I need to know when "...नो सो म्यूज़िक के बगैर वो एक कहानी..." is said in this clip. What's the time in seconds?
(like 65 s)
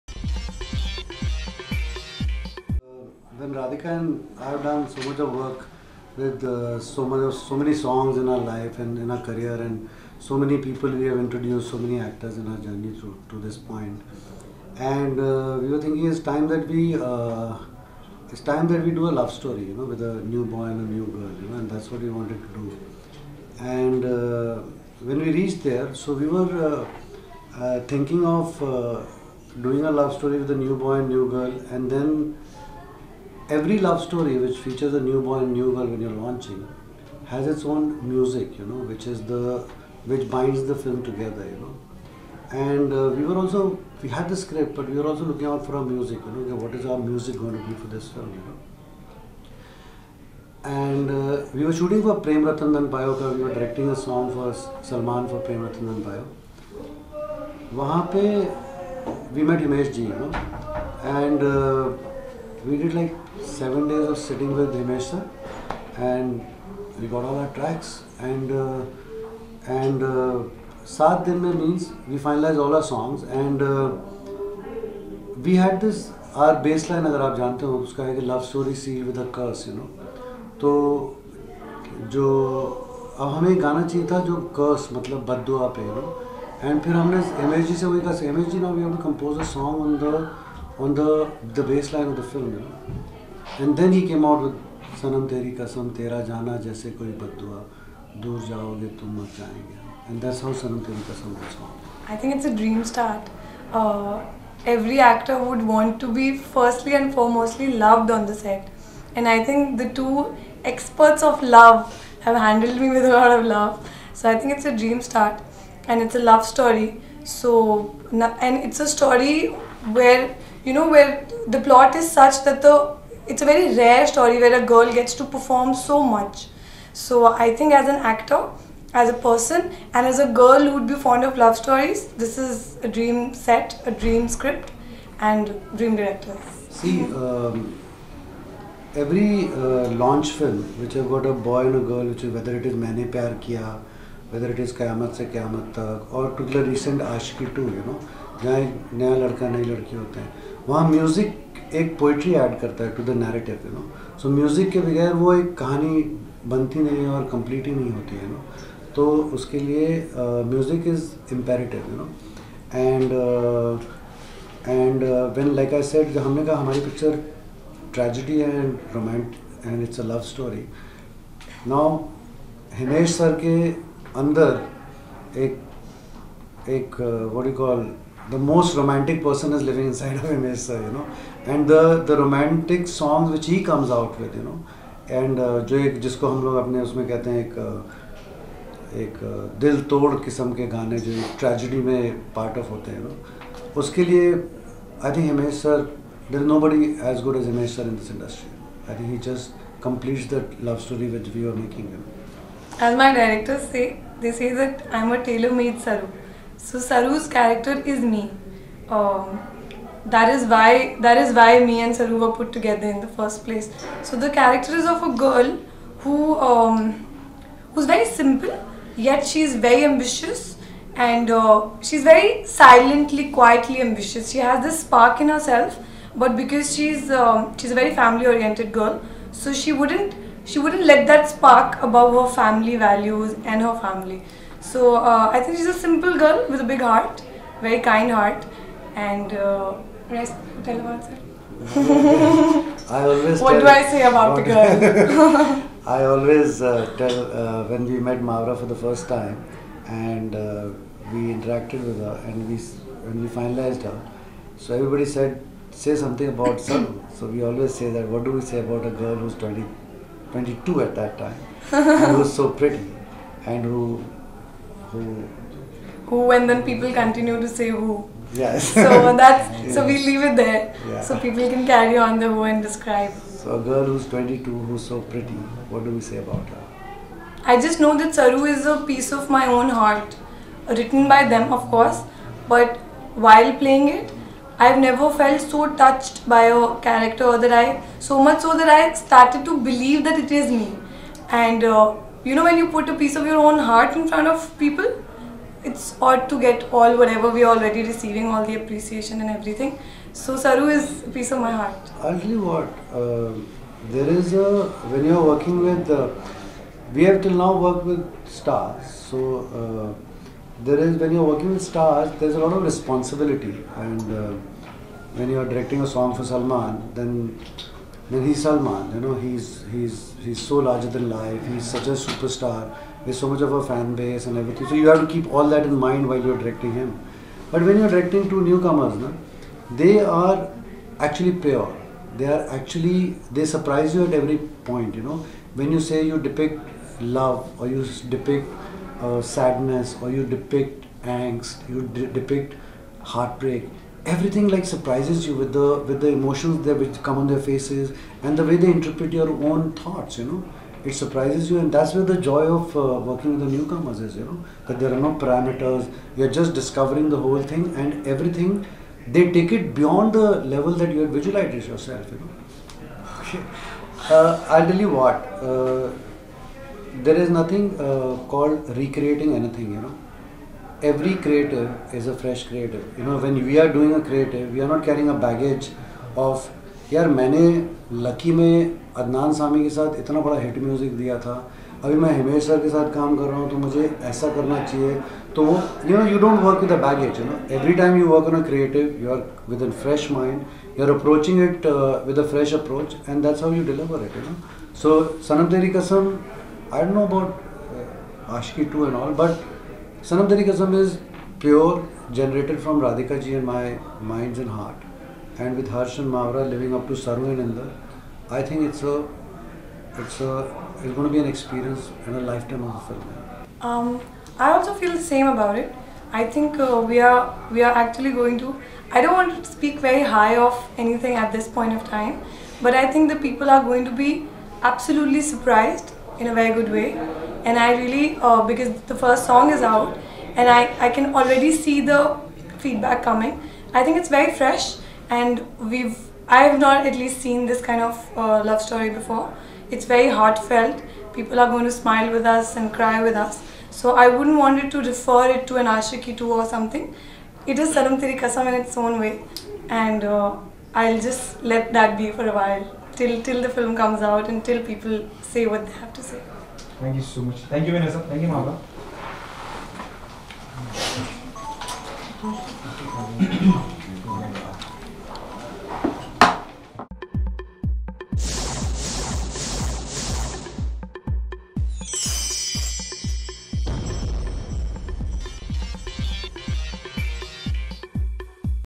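153 s.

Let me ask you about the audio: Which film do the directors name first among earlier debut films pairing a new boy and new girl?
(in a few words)
Maine Pyar Kiya.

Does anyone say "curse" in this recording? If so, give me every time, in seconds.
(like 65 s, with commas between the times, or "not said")
79 s.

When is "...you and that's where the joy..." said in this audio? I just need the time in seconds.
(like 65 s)
351 s.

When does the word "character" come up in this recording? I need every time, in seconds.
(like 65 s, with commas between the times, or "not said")
207 s, 214 s, 286 s.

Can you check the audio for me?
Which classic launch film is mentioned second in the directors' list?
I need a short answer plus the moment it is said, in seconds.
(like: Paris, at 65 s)
Kayamat Se Kayamat Tak, at 144 s.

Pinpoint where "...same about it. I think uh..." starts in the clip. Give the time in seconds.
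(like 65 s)
415 s.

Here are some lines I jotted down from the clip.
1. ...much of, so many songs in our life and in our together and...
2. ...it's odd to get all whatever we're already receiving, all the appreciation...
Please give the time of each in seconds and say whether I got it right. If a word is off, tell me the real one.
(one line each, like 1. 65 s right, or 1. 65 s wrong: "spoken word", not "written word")
1. 7 s wrong: "career", not "together"
2. 295 s right.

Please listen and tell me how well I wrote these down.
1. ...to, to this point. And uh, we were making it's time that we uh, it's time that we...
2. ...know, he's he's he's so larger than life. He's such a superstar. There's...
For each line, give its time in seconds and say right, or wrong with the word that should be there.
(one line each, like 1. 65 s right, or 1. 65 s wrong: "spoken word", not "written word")
1. 12 s wrong: "thinking", not "making"
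2. 318 s right.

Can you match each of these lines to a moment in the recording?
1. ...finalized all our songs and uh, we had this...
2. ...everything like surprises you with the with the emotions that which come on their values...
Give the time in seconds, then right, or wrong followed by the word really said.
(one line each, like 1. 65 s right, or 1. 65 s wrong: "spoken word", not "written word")
1. 72 s right
2. 344 s wrong: "faces", not "values".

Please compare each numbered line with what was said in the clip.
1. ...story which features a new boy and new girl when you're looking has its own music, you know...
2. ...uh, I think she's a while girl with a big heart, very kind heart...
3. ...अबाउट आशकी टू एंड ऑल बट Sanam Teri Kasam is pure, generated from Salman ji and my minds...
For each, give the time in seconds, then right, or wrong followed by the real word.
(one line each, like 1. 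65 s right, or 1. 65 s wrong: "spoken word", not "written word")
1. 34 s wrong: "launching", not "looking"
2. 234 s wrong: "simple", not "while"
3. 397 s wrong: "Radhika", not "Salman".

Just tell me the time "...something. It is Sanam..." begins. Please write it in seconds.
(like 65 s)
446 s.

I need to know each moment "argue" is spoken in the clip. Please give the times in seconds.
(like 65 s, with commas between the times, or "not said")
not said.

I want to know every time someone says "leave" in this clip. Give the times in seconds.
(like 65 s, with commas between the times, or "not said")
270 s.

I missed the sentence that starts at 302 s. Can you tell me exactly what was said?
Actually, what, uh, there is a, when you're working with, uh, we have till now worked with stars.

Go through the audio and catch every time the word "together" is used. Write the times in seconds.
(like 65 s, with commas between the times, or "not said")
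41 s, 212 s.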